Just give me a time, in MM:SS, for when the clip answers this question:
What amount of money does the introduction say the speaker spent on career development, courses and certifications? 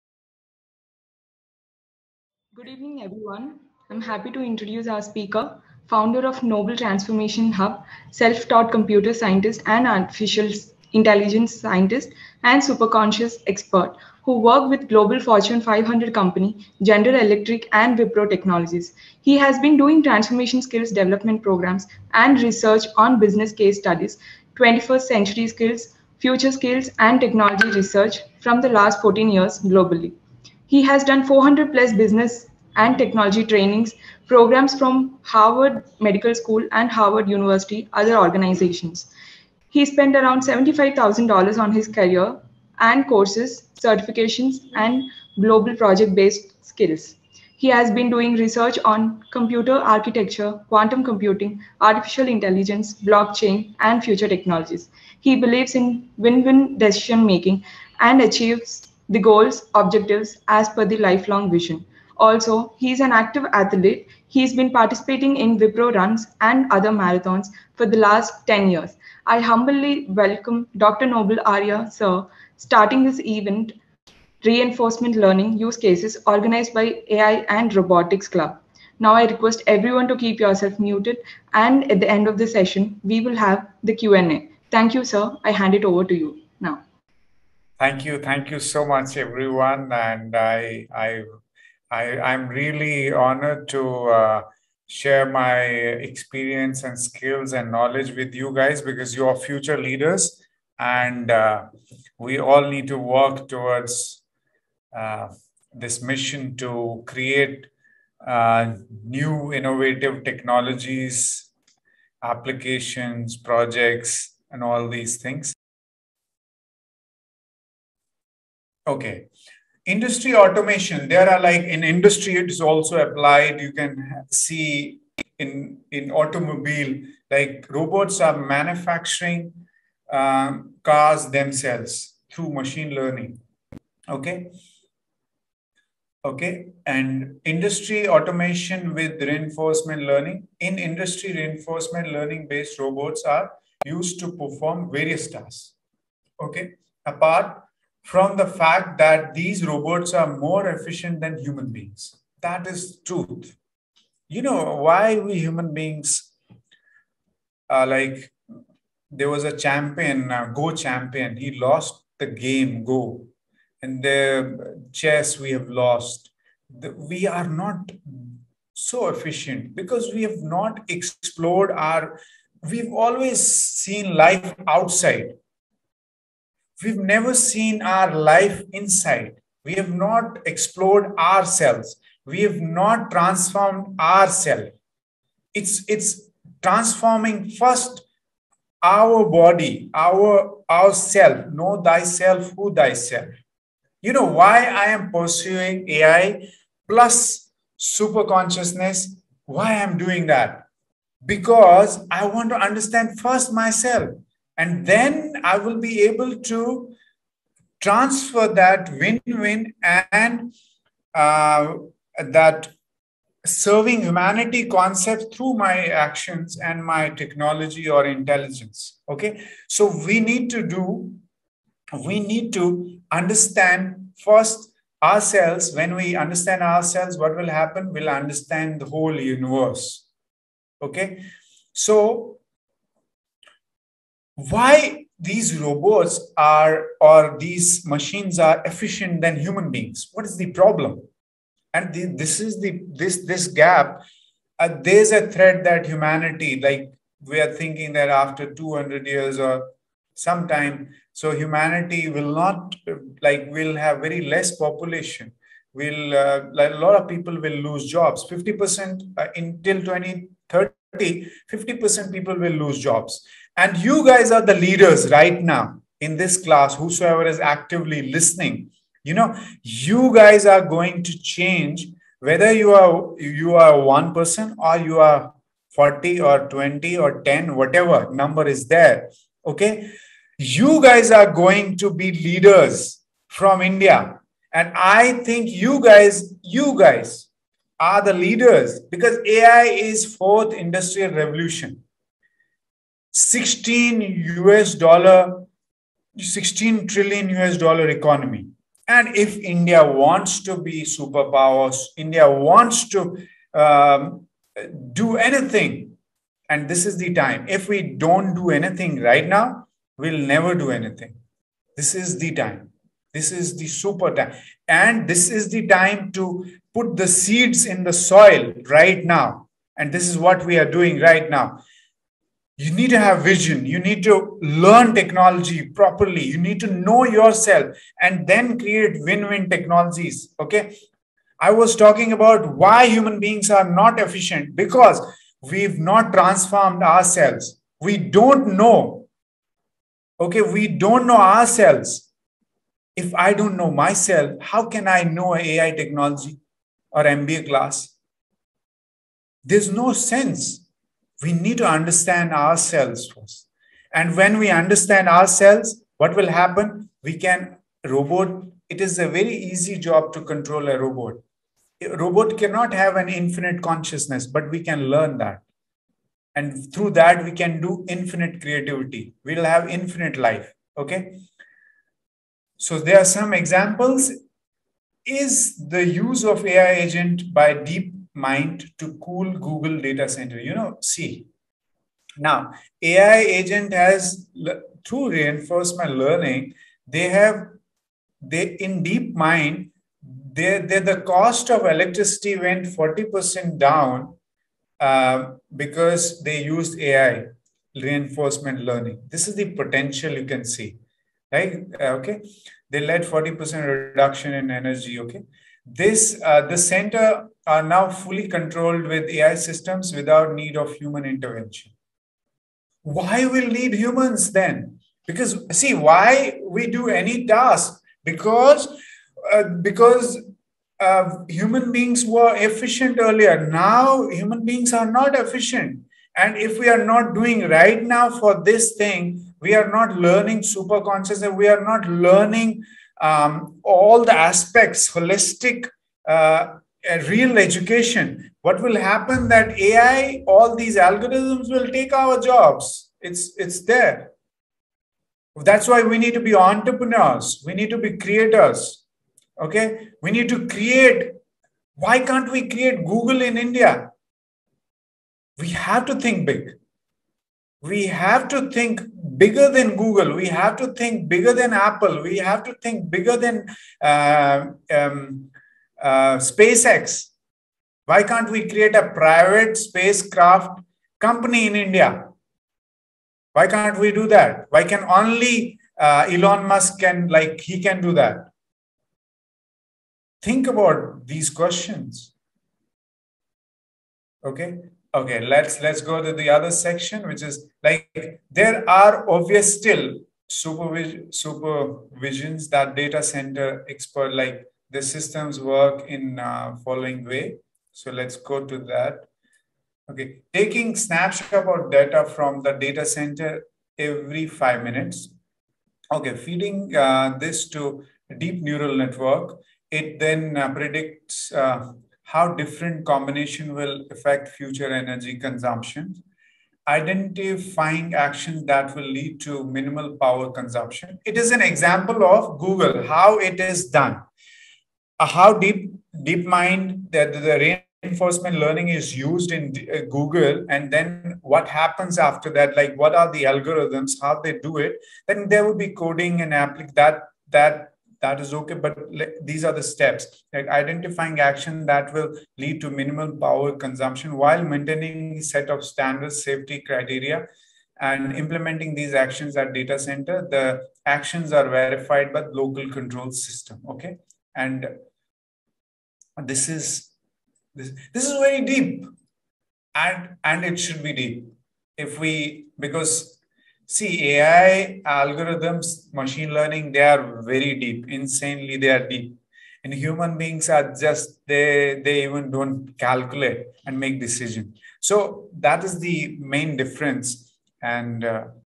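00:40.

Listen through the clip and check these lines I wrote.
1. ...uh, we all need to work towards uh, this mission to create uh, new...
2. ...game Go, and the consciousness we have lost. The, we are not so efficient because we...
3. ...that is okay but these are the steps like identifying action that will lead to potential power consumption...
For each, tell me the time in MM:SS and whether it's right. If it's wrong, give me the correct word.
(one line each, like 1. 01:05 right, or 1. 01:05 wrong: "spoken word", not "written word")
1. 01:41 right
2. 02:42 wrong: "chess", not "consciousness"
3. 08:58 wrong: "minimal", not "potential".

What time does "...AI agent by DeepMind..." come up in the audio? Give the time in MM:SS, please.
06:16.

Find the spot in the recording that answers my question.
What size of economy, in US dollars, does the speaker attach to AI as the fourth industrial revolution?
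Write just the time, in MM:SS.
04:56.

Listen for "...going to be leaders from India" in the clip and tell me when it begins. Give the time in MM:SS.
04:41.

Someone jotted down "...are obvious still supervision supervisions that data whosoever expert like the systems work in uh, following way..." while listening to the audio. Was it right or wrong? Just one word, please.
wrong.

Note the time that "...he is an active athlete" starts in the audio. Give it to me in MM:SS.
01:02.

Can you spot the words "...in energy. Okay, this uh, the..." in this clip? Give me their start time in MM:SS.
06:44.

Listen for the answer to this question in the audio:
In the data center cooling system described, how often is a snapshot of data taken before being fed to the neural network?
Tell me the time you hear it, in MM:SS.
08:23.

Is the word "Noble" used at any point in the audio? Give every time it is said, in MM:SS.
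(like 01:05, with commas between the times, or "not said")
00:06, 01:11.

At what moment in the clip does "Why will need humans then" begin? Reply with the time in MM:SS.
06:52.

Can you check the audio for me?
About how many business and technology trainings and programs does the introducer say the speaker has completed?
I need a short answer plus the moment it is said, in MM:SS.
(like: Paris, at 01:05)
400 plus, at 00:31.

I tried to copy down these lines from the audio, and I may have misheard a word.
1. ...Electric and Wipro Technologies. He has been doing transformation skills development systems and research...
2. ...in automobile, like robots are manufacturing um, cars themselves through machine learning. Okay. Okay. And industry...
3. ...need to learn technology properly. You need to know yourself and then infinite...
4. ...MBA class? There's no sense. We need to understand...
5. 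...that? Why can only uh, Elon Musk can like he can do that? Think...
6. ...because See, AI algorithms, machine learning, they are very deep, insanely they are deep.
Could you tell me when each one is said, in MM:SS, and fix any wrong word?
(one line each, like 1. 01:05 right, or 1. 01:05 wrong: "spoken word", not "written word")
1. 00:17 wrong: "programs", not "systems"
2. 02:05 right
3. 05:23 wrong: "create", not "infinite"
4. 05:47 right
5. 07:54 right
6. 09:22 right.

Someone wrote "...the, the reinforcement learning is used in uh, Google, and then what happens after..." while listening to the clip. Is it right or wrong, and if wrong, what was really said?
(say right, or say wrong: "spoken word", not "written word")
right.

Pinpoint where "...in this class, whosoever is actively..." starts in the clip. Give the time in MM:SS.
04:25.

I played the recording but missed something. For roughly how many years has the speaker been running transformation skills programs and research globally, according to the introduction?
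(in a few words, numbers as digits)
14 years.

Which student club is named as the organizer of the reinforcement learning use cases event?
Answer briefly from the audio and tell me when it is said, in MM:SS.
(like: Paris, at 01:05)
AI and Robotics Club, at 01:17.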